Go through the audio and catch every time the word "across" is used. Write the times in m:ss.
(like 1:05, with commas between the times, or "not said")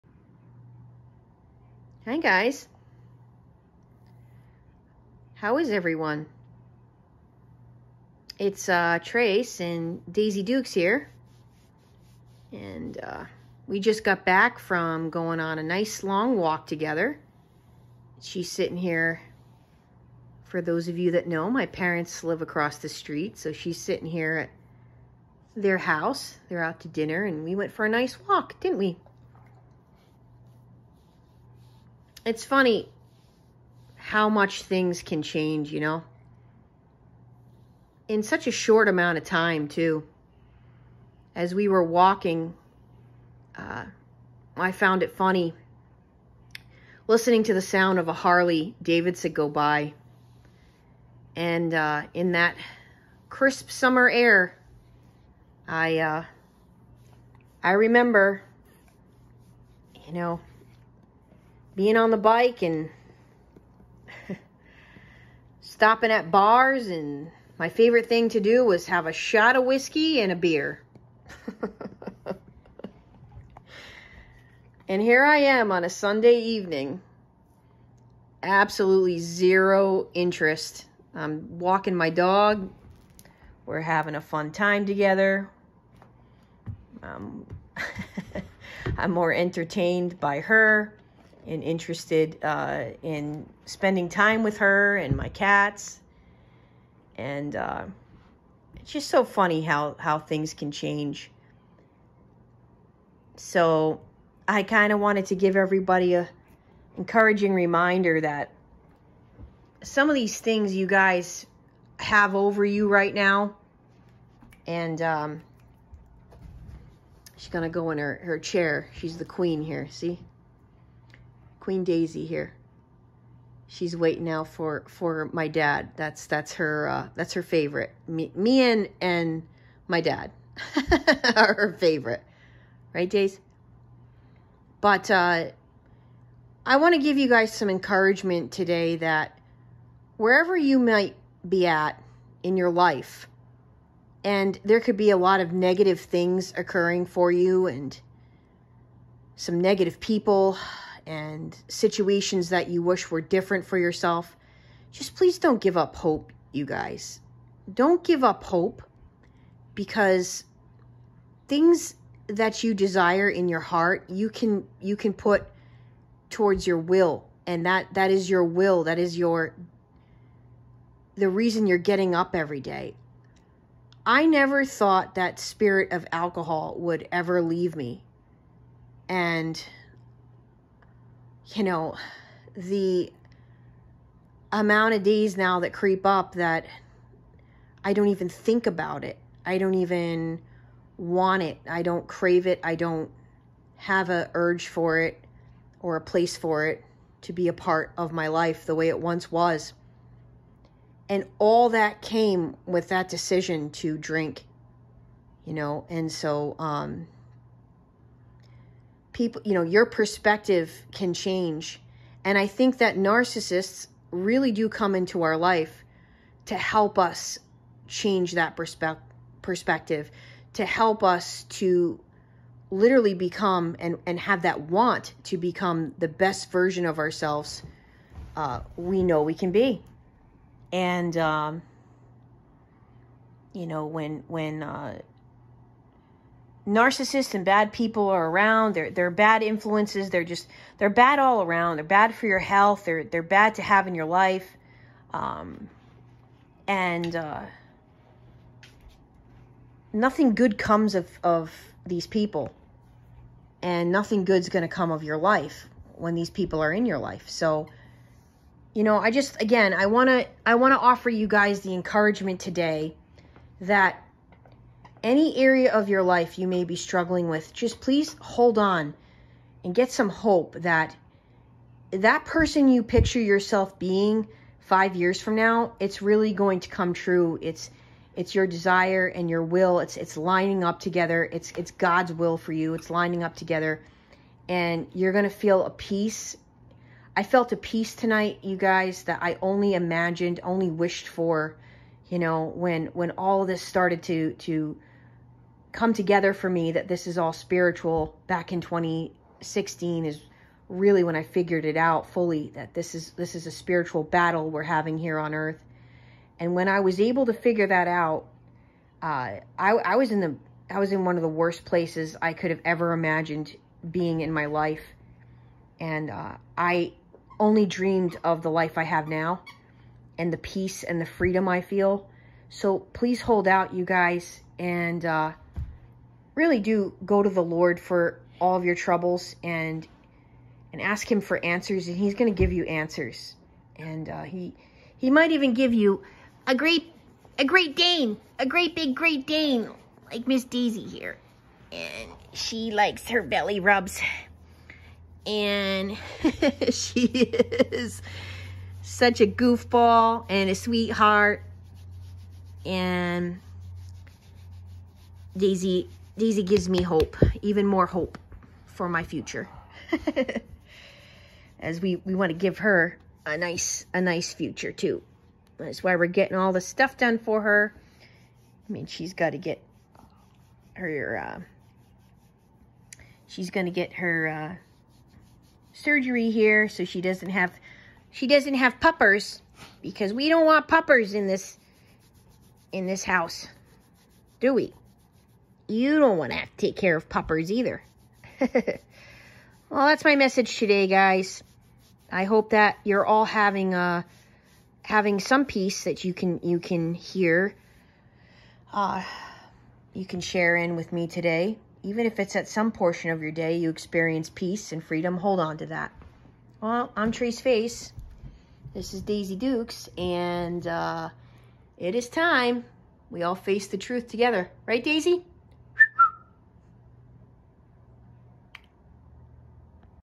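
0:22.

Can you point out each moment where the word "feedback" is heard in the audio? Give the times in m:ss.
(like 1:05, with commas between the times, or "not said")
not said.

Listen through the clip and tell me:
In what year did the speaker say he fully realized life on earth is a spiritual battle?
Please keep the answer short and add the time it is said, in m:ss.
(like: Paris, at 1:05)
2016, at 4:58.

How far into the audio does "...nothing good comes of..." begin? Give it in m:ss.
4:09.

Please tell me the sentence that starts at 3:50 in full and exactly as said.
And, um, you know, when, when, uh, narcissists and bad people are around.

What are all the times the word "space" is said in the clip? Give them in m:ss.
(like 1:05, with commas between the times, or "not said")
not said.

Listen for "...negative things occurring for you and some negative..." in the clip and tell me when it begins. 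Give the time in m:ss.
2:25.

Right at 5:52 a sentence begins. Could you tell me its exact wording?
And Daisy Daisy gives me hope, even more hope for my future.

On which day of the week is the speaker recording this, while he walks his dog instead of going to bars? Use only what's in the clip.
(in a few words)
Sunday.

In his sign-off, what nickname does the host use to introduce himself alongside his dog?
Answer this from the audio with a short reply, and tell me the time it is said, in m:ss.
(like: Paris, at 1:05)
Trace Face, at 6:47.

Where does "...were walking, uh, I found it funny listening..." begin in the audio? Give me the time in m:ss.
0:41.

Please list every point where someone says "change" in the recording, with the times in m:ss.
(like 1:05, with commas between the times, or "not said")
0:35, 1:40, 3:31, 3:37.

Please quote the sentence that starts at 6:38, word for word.
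Uh, you can share in with me today.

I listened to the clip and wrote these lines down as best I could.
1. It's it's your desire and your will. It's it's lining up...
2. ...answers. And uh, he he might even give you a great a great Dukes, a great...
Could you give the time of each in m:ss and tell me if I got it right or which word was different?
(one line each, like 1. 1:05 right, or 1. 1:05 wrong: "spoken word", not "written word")
1. 4:37 right
2. 5:32 wrong: "Dane", not "Dukes".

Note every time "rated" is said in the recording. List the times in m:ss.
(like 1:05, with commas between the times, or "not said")
not said.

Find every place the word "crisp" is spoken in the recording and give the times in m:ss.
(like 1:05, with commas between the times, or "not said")
0:53.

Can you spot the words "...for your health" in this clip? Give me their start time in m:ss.
4:02.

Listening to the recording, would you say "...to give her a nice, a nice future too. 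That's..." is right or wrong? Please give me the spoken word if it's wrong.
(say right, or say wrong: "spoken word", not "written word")
right.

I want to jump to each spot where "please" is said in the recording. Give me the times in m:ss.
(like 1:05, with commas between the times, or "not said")
2:35, 4:27, 5:22.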